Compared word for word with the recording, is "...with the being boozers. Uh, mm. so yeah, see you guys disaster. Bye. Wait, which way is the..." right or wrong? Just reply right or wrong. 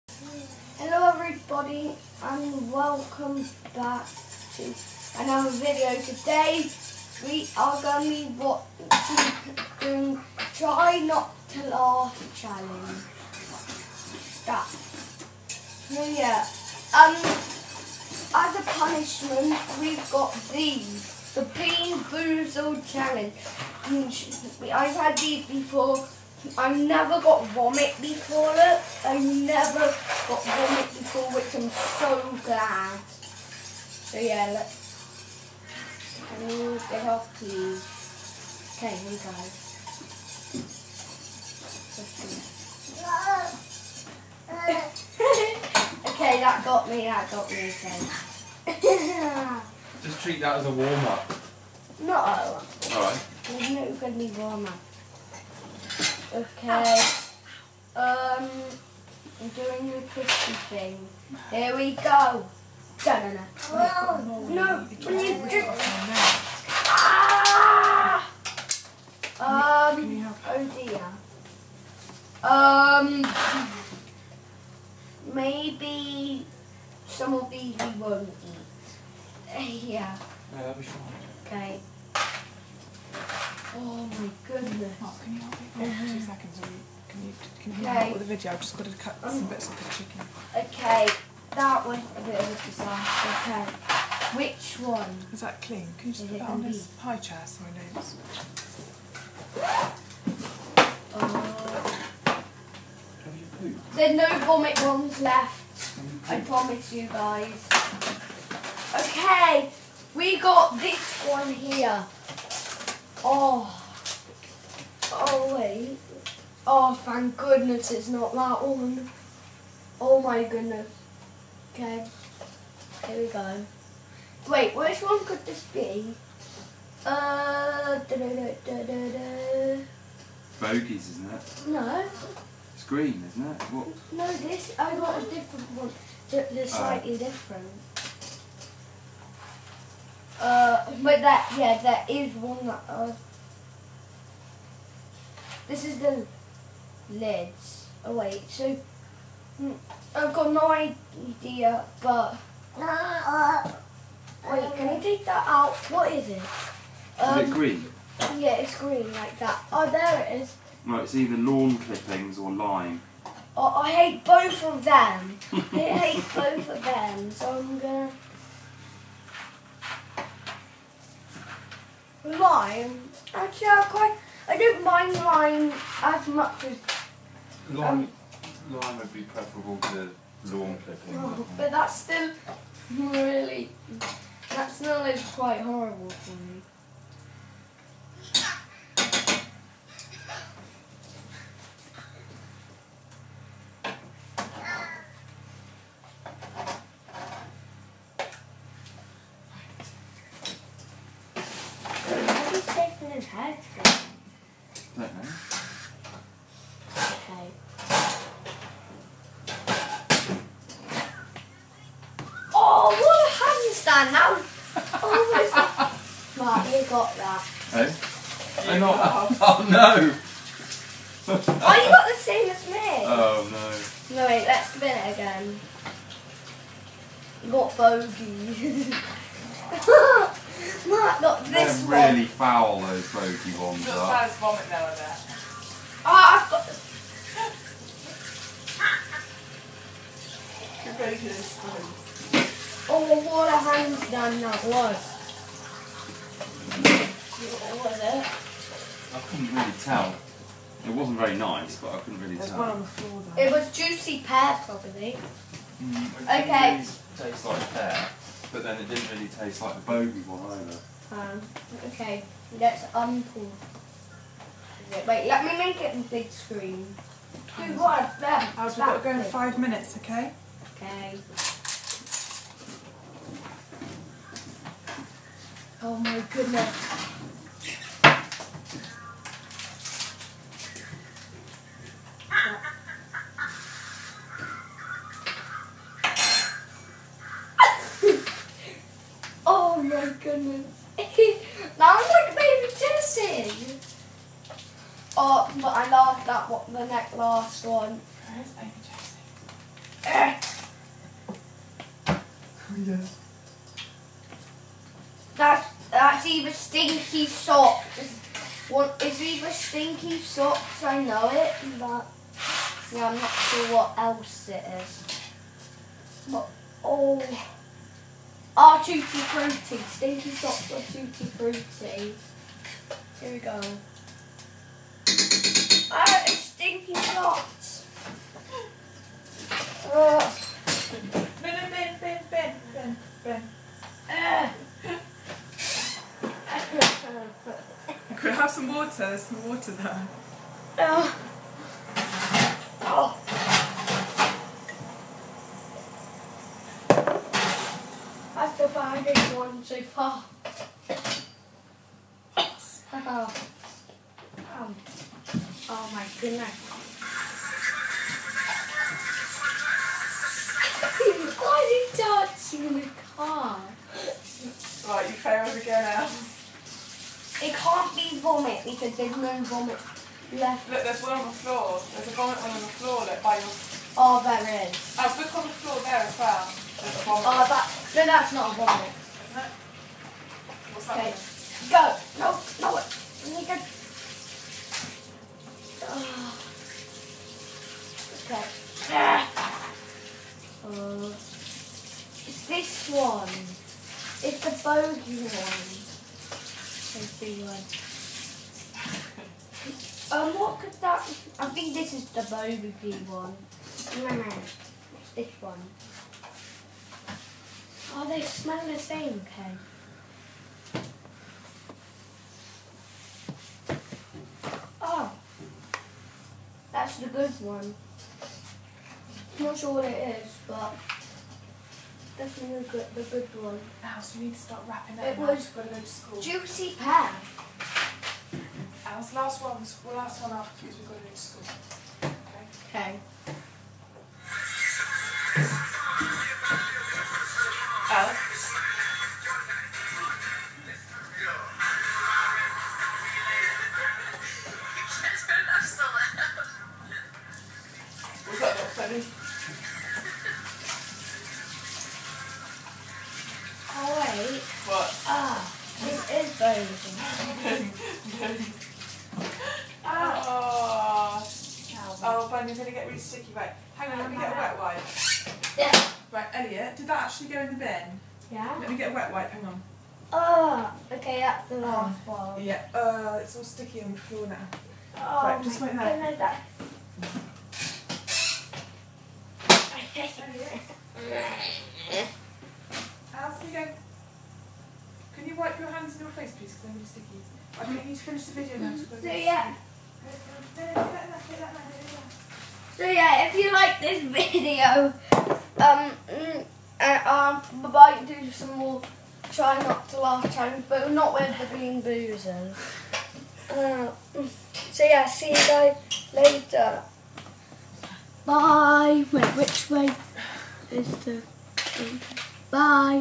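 wrong.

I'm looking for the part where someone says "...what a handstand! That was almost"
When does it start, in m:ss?
3:32.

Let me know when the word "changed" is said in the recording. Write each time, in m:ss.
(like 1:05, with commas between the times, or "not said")
not said.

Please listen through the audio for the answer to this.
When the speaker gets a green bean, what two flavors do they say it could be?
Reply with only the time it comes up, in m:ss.
2:41.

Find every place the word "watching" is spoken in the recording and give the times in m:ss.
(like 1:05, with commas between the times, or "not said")
0:08.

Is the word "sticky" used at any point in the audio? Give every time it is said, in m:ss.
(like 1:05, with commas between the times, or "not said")
7:42, 7:53, 8:06.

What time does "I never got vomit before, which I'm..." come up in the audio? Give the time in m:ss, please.
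0:29.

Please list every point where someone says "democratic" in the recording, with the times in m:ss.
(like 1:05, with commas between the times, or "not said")
not said.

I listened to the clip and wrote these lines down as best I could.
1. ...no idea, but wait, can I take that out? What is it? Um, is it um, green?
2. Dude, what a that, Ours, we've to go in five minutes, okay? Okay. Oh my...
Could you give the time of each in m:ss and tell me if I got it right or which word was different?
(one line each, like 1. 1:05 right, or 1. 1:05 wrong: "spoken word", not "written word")
1. 2:30 right
2. 4:27 right.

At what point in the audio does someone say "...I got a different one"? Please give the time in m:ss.
2:14.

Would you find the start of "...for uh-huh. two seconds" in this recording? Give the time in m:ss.
1:25.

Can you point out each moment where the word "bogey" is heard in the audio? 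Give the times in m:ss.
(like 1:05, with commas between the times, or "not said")
3:47, 3:53, 4:19, 6:34, 6:42.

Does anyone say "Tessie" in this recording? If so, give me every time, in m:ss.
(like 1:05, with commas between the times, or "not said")
4:58.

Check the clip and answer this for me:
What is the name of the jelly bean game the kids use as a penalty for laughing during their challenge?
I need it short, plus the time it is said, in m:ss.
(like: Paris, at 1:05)
Bean Boozle Challenge, at 0:21.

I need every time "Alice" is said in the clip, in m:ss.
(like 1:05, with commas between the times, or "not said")
6:05, 7:03, 7:08.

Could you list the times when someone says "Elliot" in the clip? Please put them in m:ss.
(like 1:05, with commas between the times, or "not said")
7:46.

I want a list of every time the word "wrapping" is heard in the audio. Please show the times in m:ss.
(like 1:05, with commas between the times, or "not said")
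7:04.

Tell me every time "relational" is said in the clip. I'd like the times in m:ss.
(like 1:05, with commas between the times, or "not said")
not said.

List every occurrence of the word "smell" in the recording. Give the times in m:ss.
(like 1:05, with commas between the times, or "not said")
3:04, 6:48.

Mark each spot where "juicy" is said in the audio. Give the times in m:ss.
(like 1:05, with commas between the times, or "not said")
4:13, 7:06.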